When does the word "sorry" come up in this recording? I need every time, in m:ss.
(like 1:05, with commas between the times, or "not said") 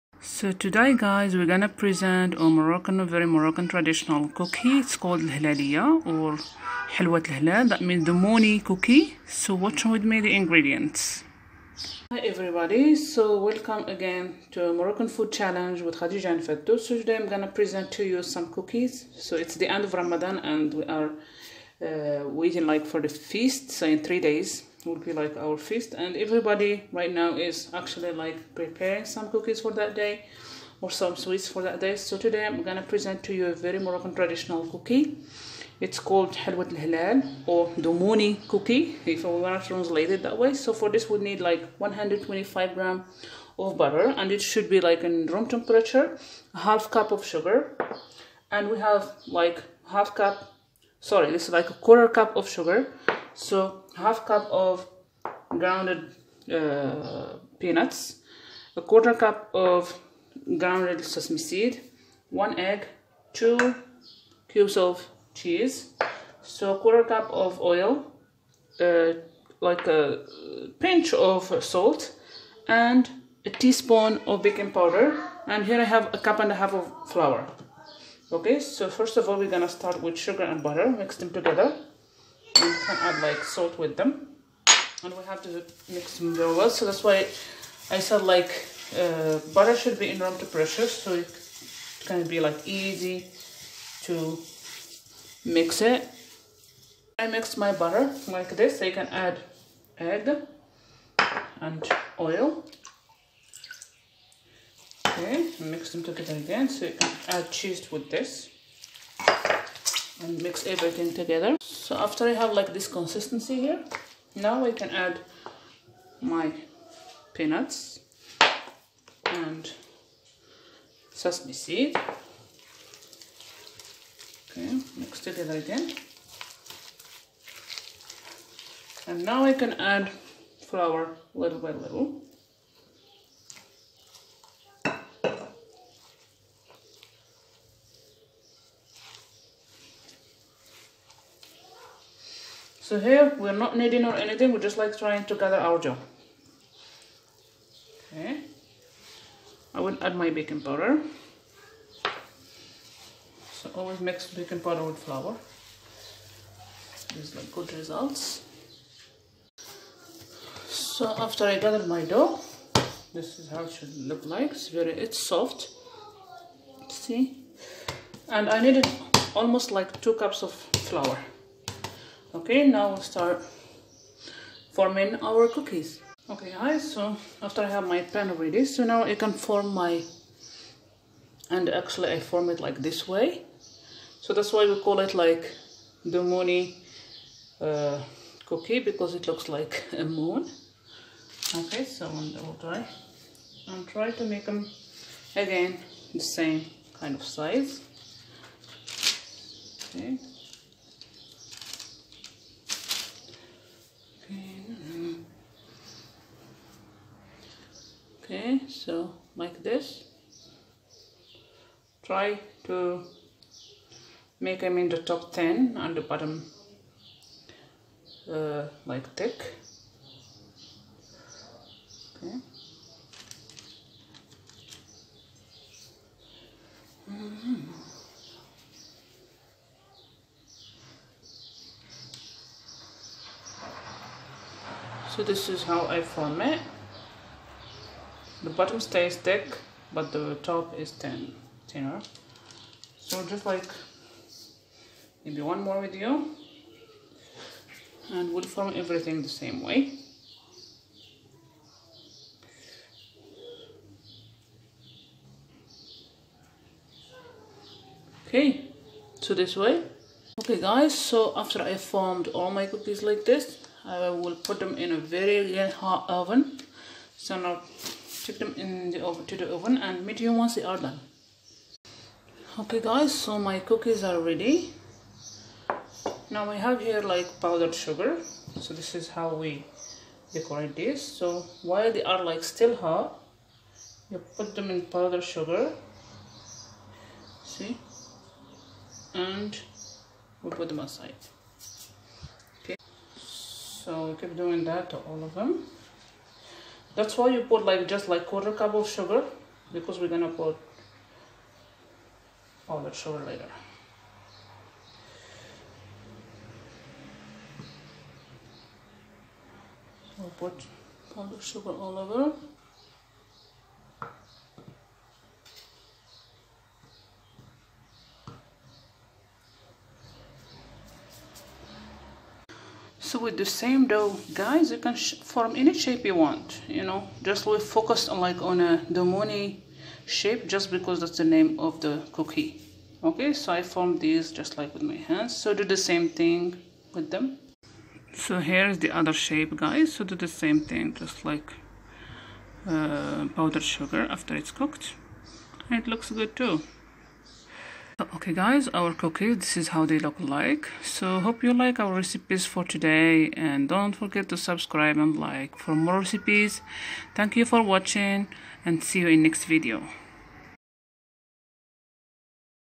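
0:50.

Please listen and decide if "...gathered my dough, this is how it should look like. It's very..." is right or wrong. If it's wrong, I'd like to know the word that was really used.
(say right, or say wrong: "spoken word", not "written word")
right.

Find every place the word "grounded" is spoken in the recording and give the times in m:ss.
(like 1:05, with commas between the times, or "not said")
0:55, 1:00.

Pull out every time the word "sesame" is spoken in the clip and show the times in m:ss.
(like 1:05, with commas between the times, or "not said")
1:01, 2:01.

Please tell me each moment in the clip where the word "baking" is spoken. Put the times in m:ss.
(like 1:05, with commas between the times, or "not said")
1:14, 2:30, 2:34.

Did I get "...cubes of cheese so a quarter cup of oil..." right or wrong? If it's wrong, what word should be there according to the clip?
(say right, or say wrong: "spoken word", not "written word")
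right.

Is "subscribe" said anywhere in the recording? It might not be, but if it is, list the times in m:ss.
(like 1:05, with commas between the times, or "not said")
5:54.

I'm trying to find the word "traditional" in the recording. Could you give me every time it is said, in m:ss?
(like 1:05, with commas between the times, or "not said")
0:03, 0:34.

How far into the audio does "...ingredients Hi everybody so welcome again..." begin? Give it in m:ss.
0:10.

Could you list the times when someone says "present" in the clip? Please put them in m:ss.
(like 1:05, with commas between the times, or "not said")
0:01, 0:17, 0:32.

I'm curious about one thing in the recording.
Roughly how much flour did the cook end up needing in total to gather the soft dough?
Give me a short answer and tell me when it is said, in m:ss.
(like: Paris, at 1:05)
2 cups, at 2:50.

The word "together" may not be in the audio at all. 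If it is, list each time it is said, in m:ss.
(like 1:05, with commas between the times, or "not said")
1:21, 1:46, 1:51, 2:05.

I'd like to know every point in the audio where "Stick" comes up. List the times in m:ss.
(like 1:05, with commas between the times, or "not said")
4:28.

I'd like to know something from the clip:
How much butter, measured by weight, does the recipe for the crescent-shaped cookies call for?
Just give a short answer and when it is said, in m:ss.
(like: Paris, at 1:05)
125 grams, at 0:41.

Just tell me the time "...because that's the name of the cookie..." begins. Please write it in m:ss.
5:30.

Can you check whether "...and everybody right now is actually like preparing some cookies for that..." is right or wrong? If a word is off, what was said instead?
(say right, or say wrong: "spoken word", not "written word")
right.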